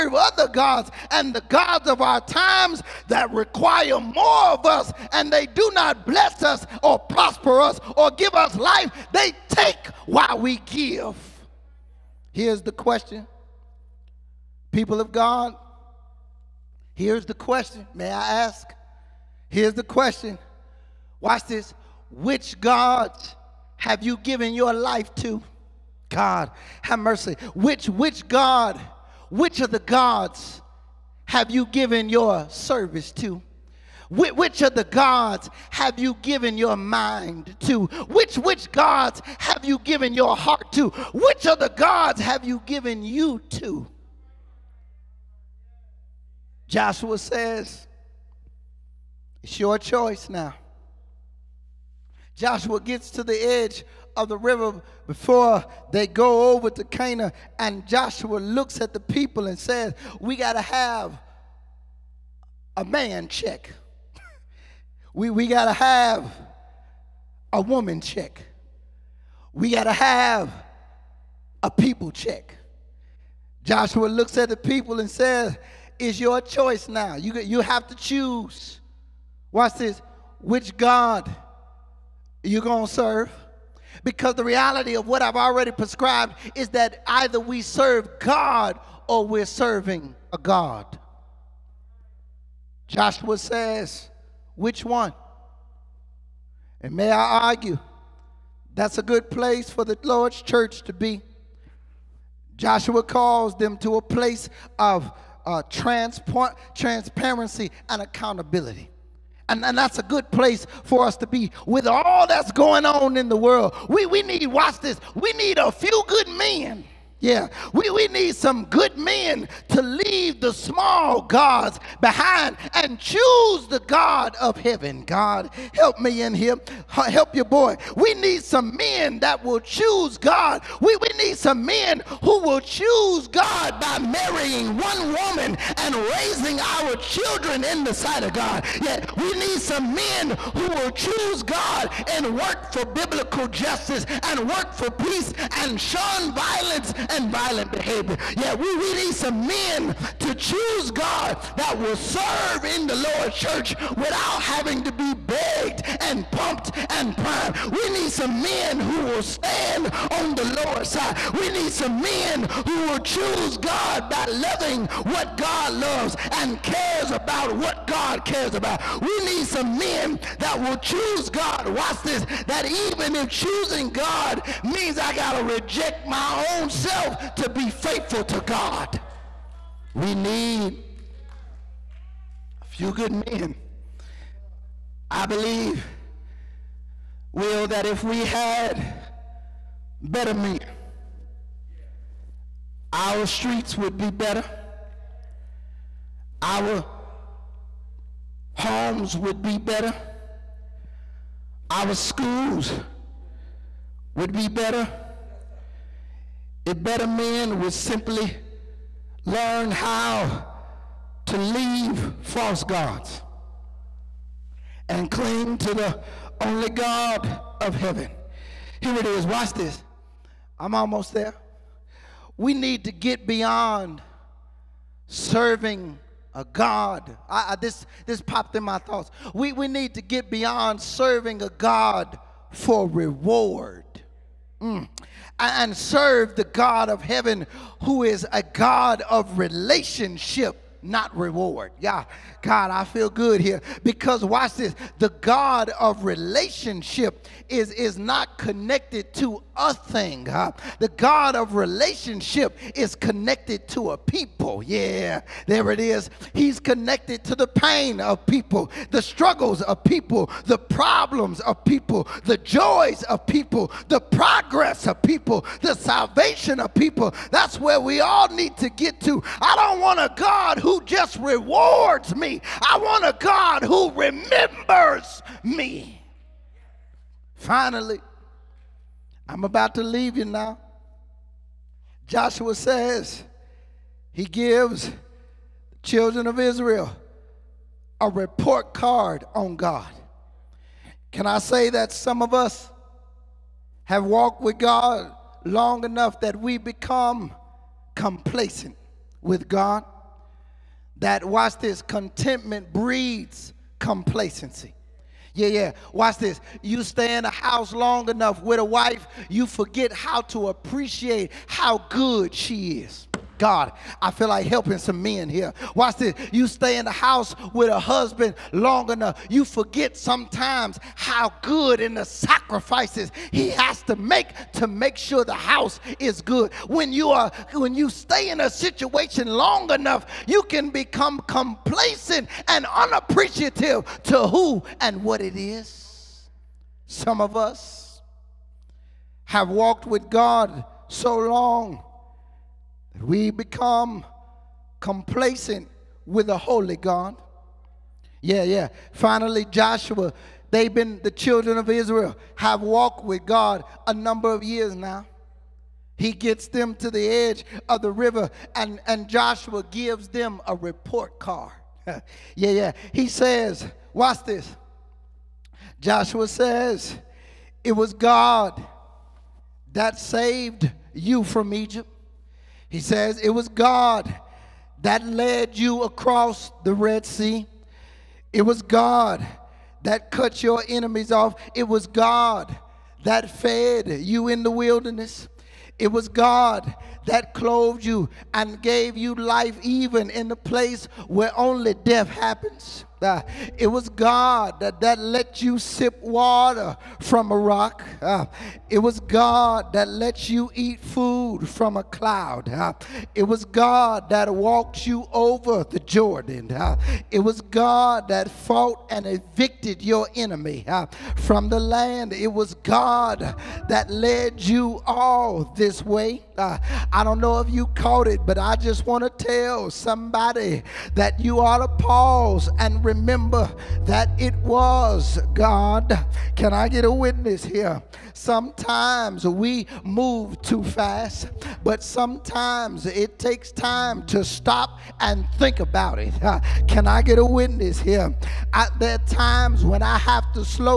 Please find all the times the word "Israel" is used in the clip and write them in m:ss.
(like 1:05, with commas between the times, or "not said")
4:46, 5:51.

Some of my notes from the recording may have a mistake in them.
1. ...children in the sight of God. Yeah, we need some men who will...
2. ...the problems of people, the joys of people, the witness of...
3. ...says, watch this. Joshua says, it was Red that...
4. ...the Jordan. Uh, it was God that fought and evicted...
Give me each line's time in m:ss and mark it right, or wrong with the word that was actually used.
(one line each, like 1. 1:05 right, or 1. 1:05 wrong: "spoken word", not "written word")
1. 2:16 right
2. 4:20 wrong: "progress", not "witness"
3. 6:03 wrong: "God", not "Red"
4. 6:45 right.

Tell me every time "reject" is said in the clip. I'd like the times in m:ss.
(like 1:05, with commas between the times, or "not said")
2:55.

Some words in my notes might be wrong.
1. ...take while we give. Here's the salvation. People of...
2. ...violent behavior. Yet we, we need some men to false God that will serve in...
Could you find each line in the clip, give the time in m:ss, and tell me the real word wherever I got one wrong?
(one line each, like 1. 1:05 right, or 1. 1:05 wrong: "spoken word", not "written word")
1. 0:09 wrong: "question", not "salvation"
2. 2:27 wrong: "choose", not "false".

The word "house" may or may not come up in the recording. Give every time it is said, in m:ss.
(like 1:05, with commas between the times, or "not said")
5:07, 5:16, 5:25.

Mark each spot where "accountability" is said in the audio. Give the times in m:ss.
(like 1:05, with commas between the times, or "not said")
1:48.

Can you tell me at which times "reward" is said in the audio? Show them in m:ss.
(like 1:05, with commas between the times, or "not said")
3:52, 4:01, 4:31.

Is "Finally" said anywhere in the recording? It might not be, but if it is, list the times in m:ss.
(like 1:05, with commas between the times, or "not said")
4:37, 5:48.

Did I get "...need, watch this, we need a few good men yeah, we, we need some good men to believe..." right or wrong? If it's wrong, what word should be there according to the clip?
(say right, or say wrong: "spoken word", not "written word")
wrong: "leave", not "believe".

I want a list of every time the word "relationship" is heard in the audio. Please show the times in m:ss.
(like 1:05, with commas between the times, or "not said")
3:59, 4:06, 4:11.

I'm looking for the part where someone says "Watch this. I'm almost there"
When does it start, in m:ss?
3:39.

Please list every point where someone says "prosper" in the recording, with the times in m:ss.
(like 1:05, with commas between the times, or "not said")
0:06.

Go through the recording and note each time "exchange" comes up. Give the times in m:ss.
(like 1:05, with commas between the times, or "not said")
not said.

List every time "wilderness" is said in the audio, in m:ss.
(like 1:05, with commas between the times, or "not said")
6:24.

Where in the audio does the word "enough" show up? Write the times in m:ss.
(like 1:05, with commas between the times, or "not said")
4:55, 5:08, 5:18, 5:29.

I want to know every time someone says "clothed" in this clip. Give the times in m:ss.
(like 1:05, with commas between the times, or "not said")
6:27.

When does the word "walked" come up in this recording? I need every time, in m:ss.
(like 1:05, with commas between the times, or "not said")
4:54, 5:39, 5:52, 6:44.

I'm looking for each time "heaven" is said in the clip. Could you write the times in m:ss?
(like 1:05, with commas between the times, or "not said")
2:04, 3:37, 3:57.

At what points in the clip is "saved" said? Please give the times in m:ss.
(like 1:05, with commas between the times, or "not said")
6:09.